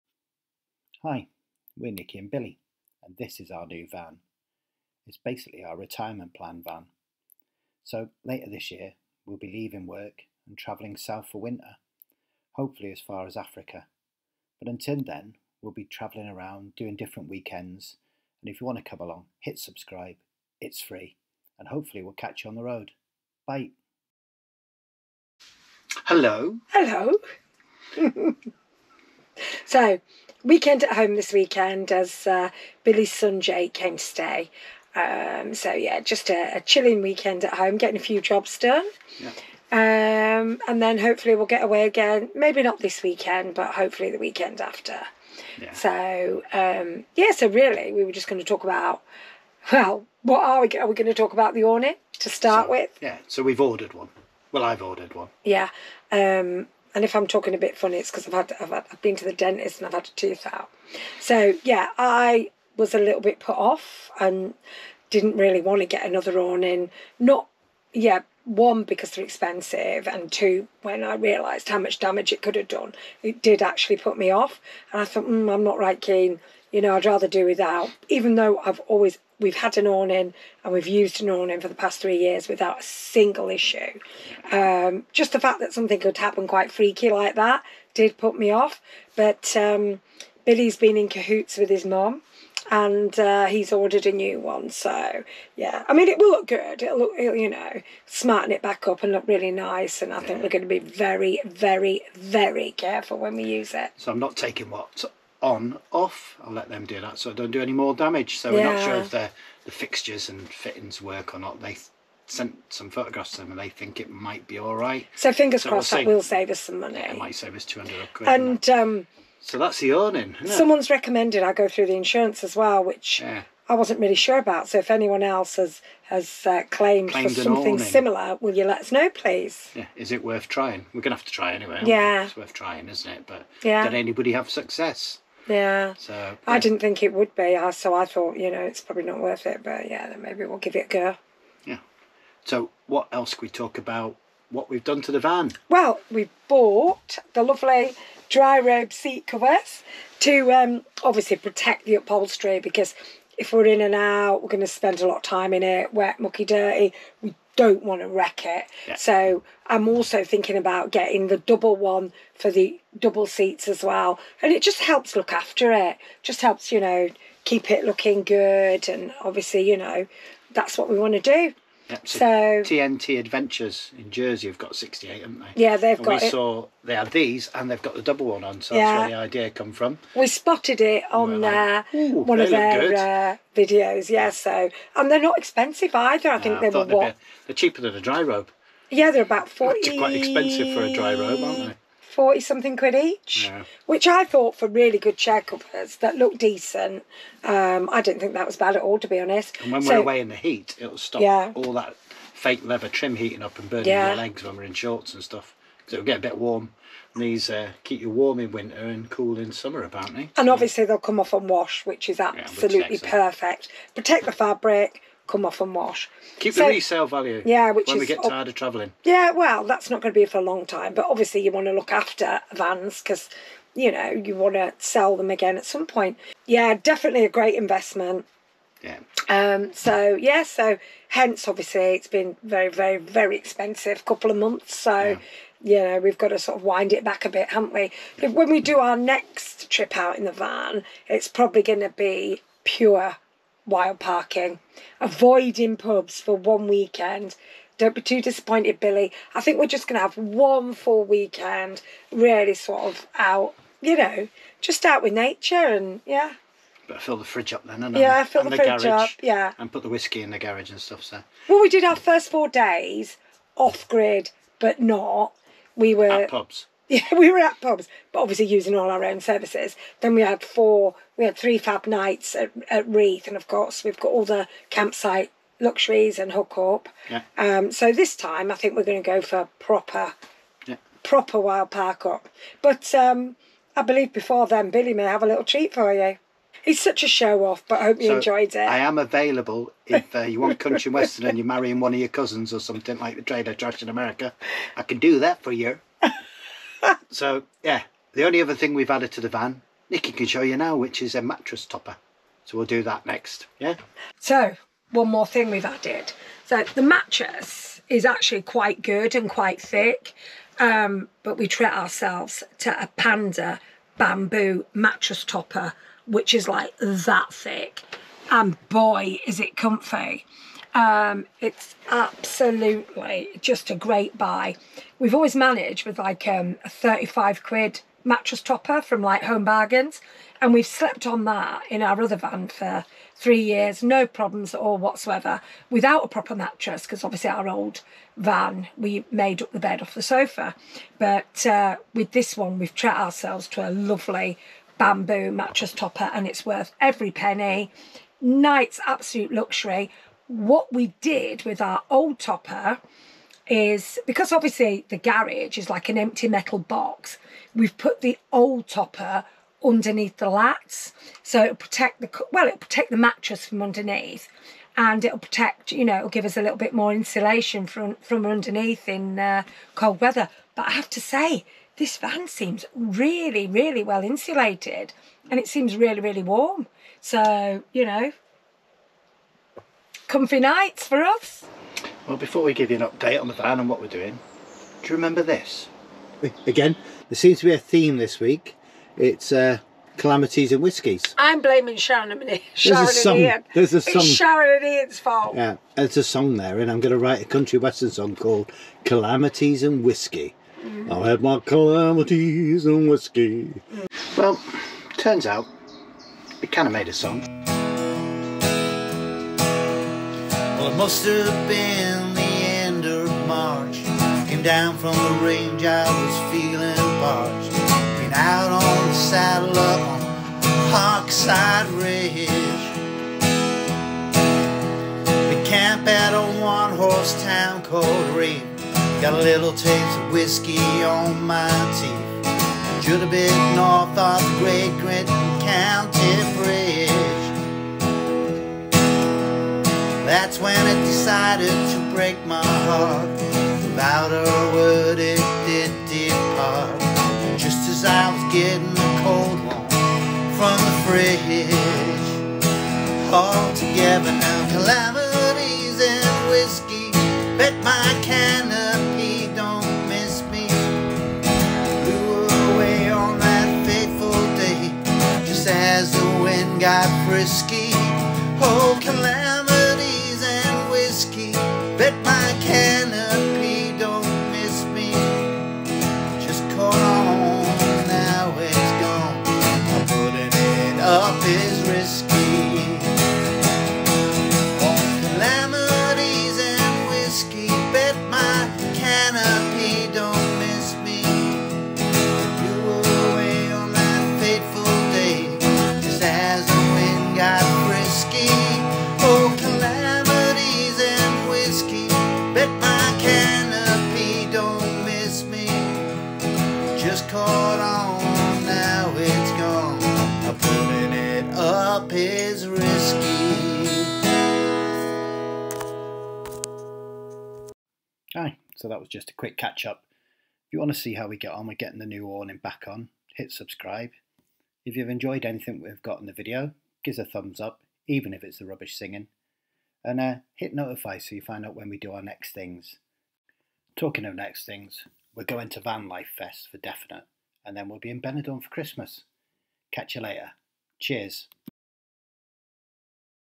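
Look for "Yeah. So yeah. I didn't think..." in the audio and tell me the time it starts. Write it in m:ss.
2:15.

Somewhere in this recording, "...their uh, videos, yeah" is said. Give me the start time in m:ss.
3:02.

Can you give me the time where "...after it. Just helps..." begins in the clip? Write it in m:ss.
2:45.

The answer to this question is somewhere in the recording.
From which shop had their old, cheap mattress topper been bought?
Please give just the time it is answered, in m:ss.
5:29.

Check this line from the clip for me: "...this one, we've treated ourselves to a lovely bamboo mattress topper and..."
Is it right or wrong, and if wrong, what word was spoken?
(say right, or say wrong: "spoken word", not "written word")
right.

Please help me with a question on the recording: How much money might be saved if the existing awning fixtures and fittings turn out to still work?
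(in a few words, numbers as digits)
200 quid.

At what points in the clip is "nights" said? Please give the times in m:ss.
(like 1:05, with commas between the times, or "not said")
4:31, 5:48, 6:20.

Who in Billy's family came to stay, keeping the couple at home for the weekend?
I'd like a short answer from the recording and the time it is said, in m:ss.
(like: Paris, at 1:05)
Jay, at 0:33.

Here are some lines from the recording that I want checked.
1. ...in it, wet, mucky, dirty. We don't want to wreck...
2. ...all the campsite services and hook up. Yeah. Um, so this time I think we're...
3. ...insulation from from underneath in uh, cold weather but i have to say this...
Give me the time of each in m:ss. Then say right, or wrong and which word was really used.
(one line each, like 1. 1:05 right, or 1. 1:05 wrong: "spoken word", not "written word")
1. 2:35 right
2. 4:34 wrong: "luxuries", not "services"
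3. 6:06 right.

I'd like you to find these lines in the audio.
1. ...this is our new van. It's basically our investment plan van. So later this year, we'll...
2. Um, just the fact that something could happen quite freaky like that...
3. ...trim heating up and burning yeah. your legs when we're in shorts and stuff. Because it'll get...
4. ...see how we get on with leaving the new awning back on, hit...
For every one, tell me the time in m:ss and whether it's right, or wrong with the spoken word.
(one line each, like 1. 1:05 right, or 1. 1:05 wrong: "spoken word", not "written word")
1. 0:03 wrong: "retirement", not "investment"
2. 1:24 right
3. 3:22 right
4. 8:40 wrong: "getting", not "leaving".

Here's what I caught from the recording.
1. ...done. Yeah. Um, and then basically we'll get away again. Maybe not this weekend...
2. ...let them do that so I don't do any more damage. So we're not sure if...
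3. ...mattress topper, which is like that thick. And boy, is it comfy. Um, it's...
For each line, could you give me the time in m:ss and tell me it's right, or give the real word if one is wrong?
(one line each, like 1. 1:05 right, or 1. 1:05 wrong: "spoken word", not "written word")
1. 0:38 wrong: "hopefully", not "basically"
2. 1:46 right
3. 5:14 right.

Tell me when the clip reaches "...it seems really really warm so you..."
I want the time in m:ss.
6:15.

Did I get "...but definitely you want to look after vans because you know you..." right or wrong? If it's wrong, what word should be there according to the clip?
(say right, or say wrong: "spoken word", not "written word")
wrong: "obviously", not "definitely".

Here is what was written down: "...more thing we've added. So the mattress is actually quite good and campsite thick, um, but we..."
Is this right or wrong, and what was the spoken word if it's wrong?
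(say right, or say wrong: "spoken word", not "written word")
wrong: "quite", not "campsite".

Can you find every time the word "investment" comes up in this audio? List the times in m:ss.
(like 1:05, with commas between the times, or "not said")
3:47.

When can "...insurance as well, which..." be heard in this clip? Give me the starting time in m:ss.
2:01.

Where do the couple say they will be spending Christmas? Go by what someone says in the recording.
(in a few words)
Benidorm.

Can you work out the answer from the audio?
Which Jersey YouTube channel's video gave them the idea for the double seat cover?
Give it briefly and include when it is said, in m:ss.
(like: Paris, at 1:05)
TNT Adventures, at 2:52.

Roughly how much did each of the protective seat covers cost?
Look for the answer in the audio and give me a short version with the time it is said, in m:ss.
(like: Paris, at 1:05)
40 something quid, at 3:12.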